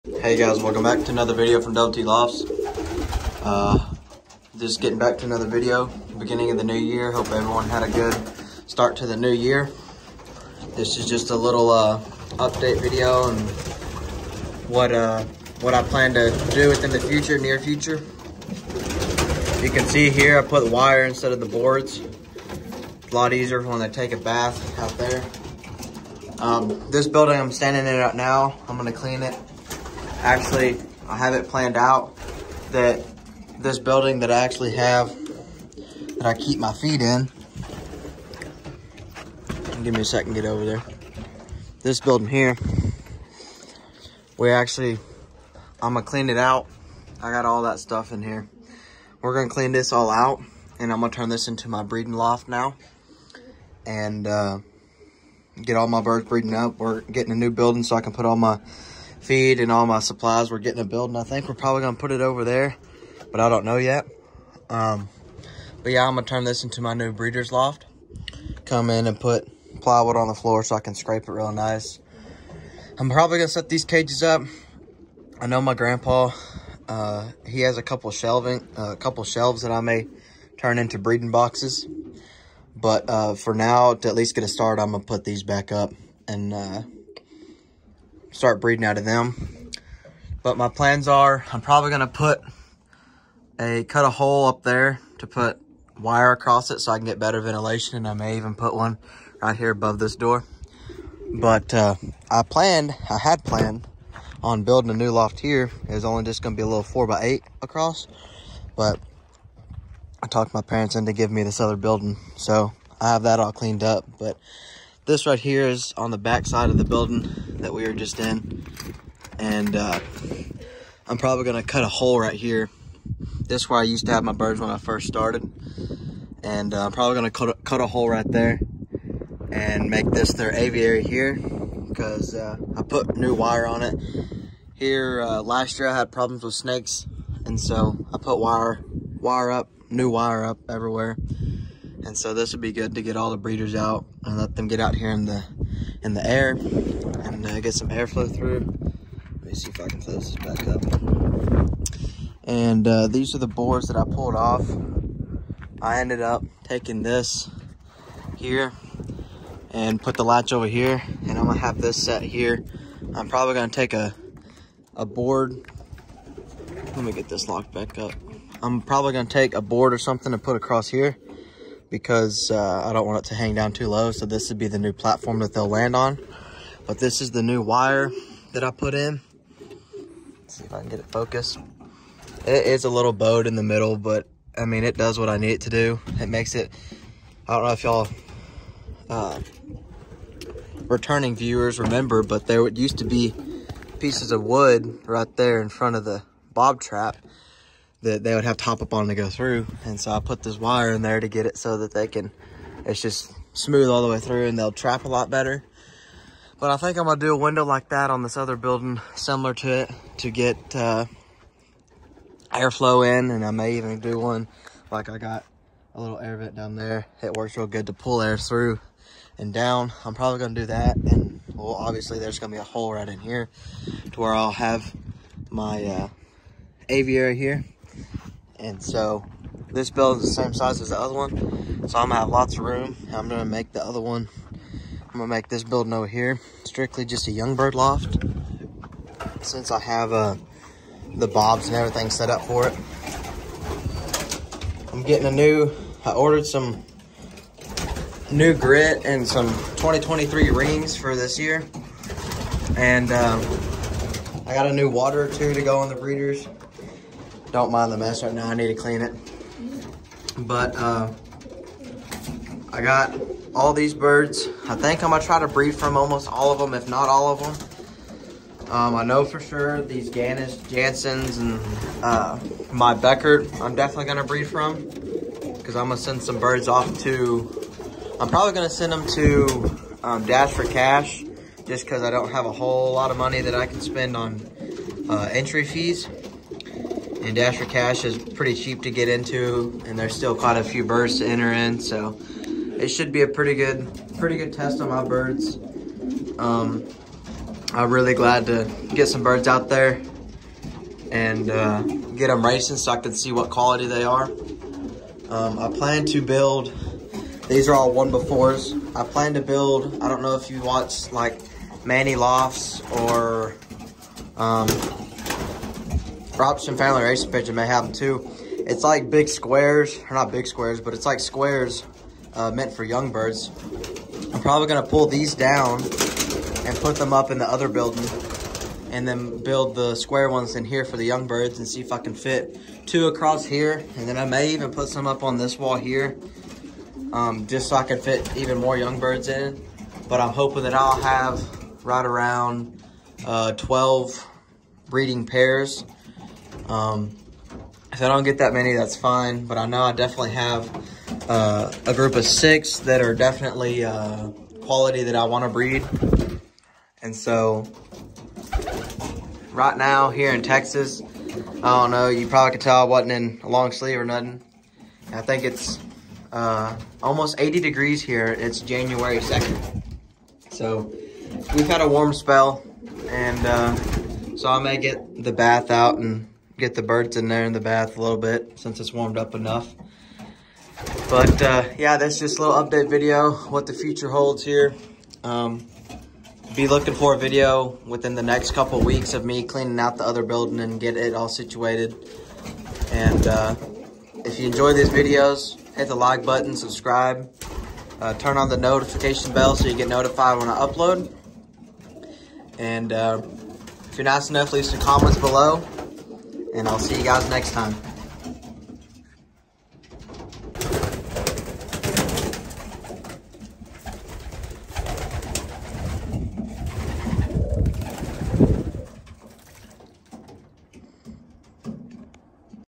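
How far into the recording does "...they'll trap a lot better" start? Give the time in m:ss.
3:24.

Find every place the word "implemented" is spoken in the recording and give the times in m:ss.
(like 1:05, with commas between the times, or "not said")
not said.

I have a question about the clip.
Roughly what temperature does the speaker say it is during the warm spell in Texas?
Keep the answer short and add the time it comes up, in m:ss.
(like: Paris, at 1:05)
80 degrees, at 6:07.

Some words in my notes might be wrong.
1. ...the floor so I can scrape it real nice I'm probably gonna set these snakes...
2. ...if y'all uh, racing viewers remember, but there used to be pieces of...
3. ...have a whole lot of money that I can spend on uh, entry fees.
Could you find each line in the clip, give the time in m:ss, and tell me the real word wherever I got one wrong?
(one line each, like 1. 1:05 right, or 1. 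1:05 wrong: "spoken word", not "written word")
1. 1:10 wrong: "cages", not "snakes"
2. 3:07 wrong: "returning", not "racing"
3. 4:42 right.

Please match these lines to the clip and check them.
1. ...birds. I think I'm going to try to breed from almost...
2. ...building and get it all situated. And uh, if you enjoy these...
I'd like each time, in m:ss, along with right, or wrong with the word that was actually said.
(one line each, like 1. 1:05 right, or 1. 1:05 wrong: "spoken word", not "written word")
1. 4:23 right
2. 6:30 right.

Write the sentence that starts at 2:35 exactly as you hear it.
I ended up taking this here and put the latch over here and I'm gonna have this set here.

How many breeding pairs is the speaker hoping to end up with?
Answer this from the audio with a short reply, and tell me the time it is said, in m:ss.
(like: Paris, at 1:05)
12, at 5:43.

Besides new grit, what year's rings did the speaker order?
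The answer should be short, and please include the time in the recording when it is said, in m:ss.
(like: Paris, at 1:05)
2023, at 4:09.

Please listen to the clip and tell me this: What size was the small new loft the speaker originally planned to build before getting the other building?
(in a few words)
4 by 8.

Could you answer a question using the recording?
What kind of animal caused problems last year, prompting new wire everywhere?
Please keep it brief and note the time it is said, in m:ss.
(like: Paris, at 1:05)
Snakes, at 2:16.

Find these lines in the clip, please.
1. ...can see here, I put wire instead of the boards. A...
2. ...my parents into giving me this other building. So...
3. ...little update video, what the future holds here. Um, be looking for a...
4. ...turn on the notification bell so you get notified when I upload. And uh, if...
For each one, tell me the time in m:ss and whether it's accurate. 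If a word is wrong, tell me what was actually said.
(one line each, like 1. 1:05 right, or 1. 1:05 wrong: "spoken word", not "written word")
1. 0:19 right
2. 1:50 right
3. 6:22 right
4. 6:38 right.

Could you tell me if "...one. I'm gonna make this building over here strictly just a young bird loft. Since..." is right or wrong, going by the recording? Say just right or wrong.
right.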